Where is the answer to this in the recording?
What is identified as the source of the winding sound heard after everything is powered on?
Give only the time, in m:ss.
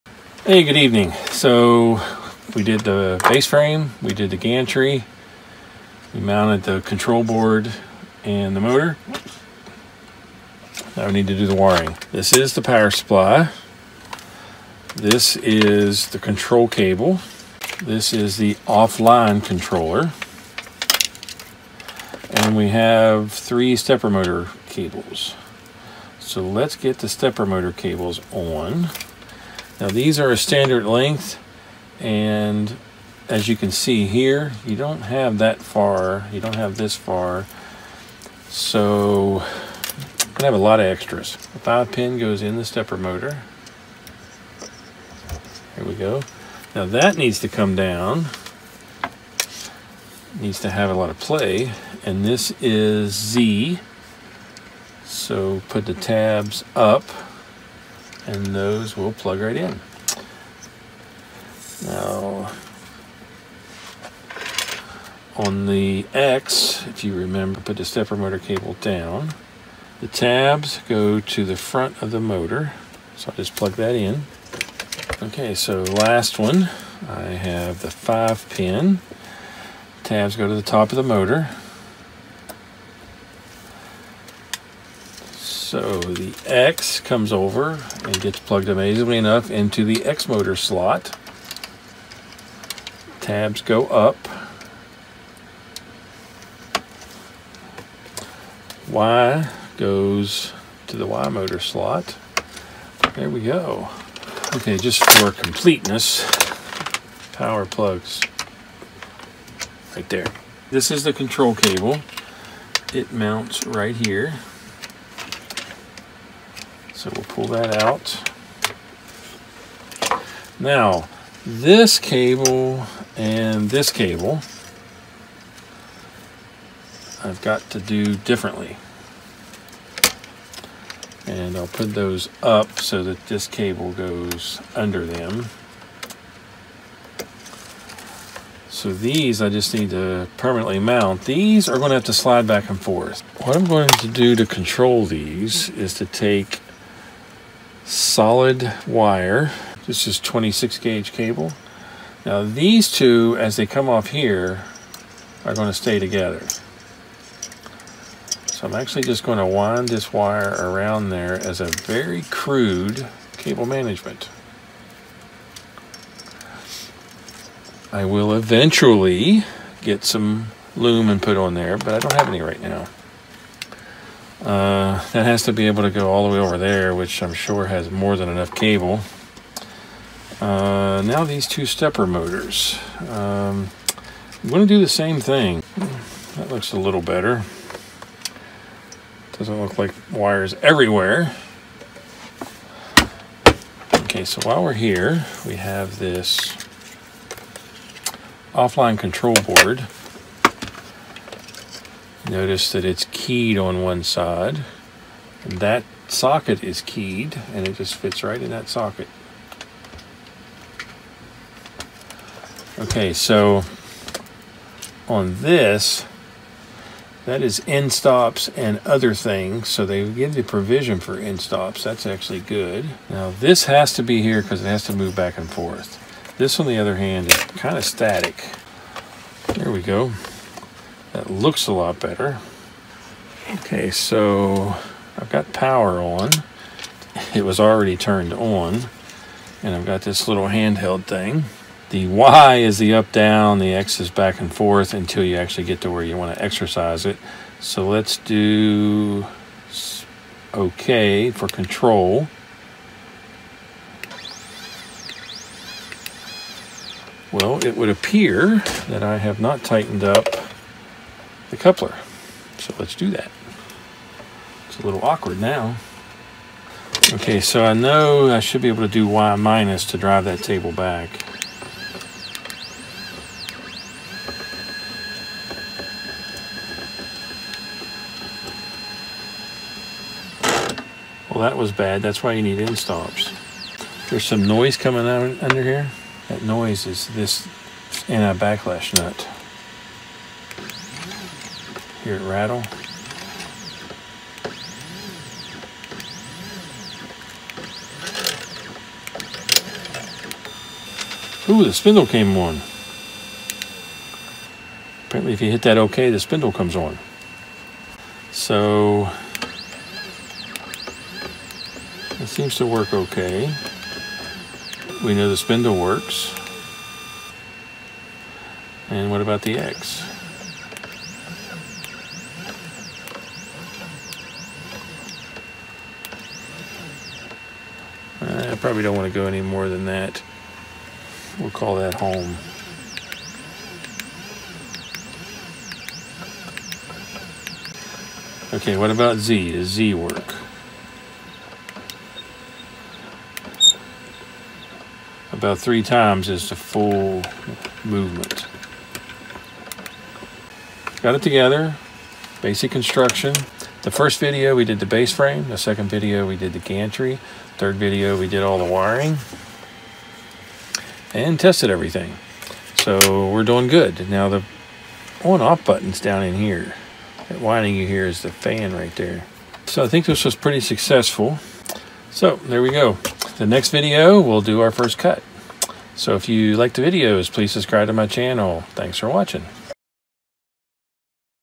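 6:08.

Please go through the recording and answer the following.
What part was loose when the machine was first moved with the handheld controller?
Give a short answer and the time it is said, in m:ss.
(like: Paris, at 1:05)
The coupler, at 4:21.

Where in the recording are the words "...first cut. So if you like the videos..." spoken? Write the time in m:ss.
6:14.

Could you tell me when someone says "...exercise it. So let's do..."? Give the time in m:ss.
4:06.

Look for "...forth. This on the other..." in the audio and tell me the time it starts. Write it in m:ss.
3:45.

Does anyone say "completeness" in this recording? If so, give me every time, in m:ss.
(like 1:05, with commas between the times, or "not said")
1:45.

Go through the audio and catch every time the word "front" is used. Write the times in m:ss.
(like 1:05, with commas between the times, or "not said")
1:11.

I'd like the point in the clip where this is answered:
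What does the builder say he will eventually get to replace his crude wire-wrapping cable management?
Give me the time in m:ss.
2:50.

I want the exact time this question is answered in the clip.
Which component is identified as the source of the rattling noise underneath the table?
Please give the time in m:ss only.
4:48.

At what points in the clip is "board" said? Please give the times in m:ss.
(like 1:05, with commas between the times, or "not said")
0:07, 3:19.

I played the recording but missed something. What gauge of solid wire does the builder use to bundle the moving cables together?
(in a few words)
26 gauge.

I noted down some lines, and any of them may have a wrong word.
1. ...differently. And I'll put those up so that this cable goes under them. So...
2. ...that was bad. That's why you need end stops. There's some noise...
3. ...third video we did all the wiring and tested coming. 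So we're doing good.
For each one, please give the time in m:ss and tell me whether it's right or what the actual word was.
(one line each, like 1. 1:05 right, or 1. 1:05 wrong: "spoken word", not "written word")
1. 2:08 right
2. 4:41 right
3. 5:57 wrong: "everything", not "coming".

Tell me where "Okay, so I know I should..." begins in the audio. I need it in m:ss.
4:27.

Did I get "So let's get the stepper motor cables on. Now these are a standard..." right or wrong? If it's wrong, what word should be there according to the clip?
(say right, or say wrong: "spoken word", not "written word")
right.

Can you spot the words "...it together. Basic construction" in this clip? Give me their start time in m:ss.
5:51.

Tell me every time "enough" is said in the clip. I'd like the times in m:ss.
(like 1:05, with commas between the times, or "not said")
1:29, 2:58.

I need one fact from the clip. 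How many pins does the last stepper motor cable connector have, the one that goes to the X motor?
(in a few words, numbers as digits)
5.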